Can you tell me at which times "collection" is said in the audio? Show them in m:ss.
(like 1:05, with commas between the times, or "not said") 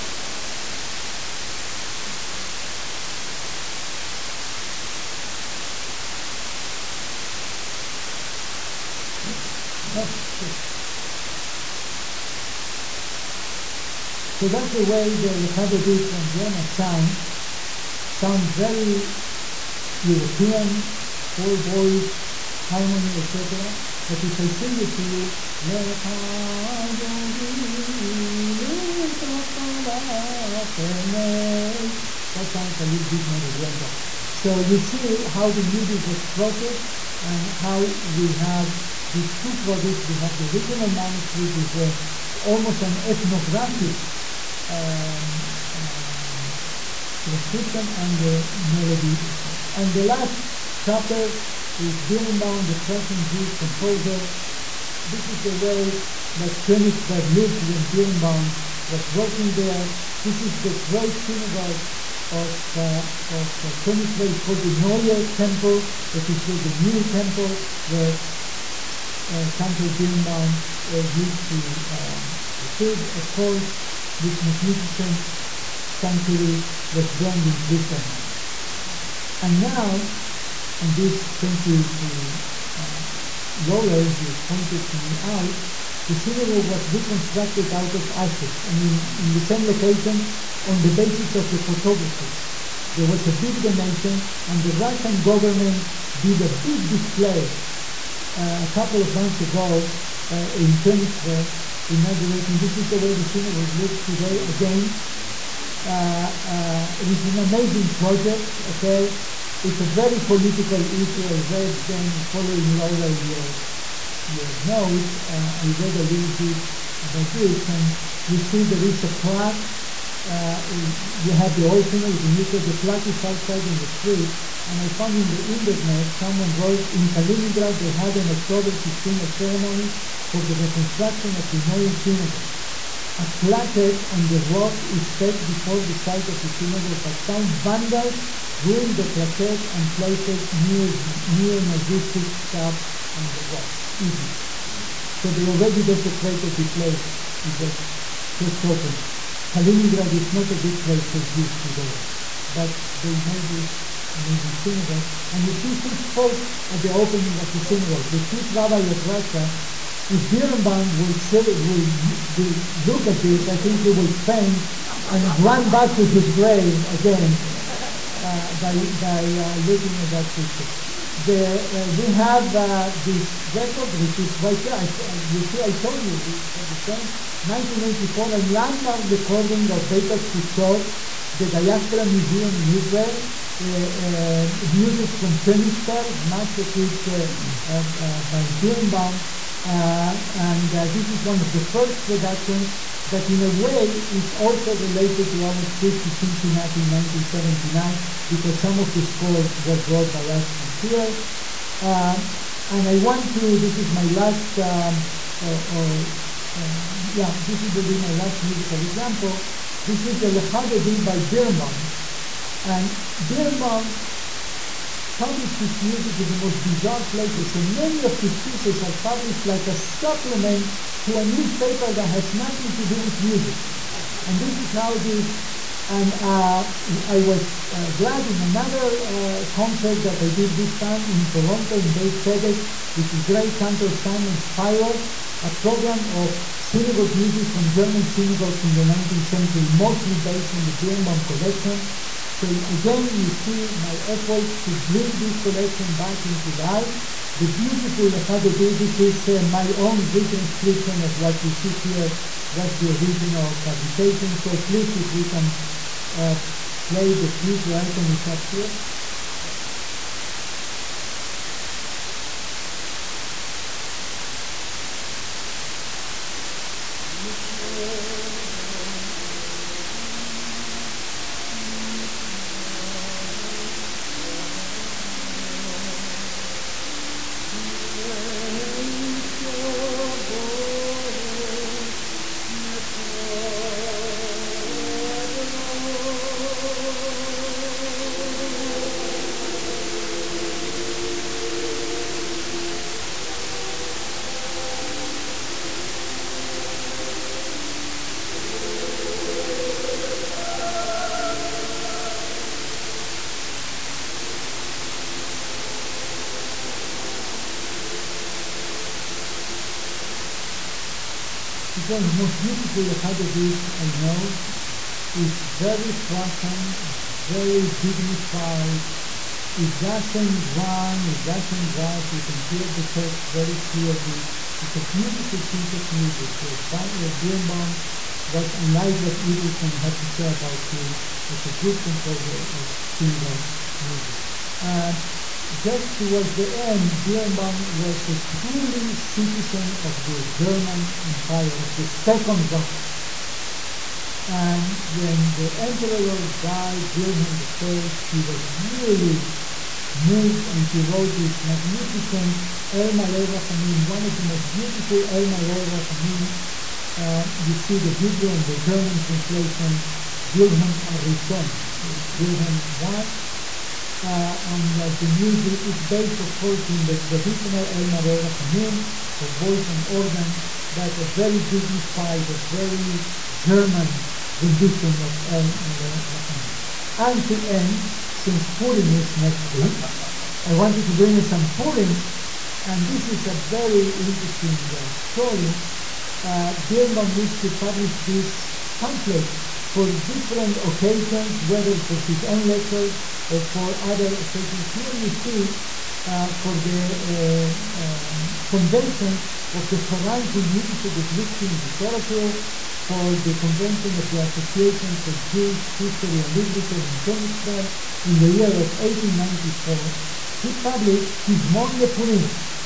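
4:01, 4:05.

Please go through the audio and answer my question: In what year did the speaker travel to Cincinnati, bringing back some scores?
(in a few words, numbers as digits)
1979.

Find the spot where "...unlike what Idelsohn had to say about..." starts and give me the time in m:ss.
5:28.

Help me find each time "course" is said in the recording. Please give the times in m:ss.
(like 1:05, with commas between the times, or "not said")
1:13, 6:06.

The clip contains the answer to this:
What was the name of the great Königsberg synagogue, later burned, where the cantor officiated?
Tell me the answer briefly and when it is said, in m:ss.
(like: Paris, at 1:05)
Neue Temple, at 1:04.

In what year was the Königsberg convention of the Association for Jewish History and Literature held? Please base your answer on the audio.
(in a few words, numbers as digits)
1894.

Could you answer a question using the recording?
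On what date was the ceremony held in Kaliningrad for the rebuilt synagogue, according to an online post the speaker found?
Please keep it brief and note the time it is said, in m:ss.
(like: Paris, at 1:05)
October 16, at 2:08.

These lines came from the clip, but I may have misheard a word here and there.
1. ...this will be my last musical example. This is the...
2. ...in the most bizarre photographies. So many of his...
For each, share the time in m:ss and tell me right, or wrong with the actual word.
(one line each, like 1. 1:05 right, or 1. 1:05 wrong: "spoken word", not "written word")
1. 3:27 right
2. 3:36 wrong: "places", not "photographies".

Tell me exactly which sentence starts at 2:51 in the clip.
The, uh, we have uh, this record, which is right here.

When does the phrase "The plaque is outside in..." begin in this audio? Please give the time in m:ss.
2:02.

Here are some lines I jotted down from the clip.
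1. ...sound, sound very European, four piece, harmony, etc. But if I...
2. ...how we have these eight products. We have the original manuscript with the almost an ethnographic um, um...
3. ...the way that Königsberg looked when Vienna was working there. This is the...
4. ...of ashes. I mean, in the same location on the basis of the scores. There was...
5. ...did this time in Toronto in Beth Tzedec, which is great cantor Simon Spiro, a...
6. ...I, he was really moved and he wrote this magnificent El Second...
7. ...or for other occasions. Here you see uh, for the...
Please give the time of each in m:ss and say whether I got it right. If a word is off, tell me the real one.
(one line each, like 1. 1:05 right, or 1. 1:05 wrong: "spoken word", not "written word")
1. 0:16 wrong: "voice", not "piece"
2. 0:37 wrong: "two", not "eight"
3. 0:55 wrong: "Birnbaum", not "Vienna"
4. 1:27 wrong: "photographies", not "scores"
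5. 3:50 right
6. 5:47 wrong: "Malay", not "Second"
7. 6:33 right.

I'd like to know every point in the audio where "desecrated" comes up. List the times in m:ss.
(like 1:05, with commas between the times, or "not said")
2:25.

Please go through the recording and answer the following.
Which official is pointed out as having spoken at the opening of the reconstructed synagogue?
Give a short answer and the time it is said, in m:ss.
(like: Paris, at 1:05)
Chief rabbi of Russia, at 2:38.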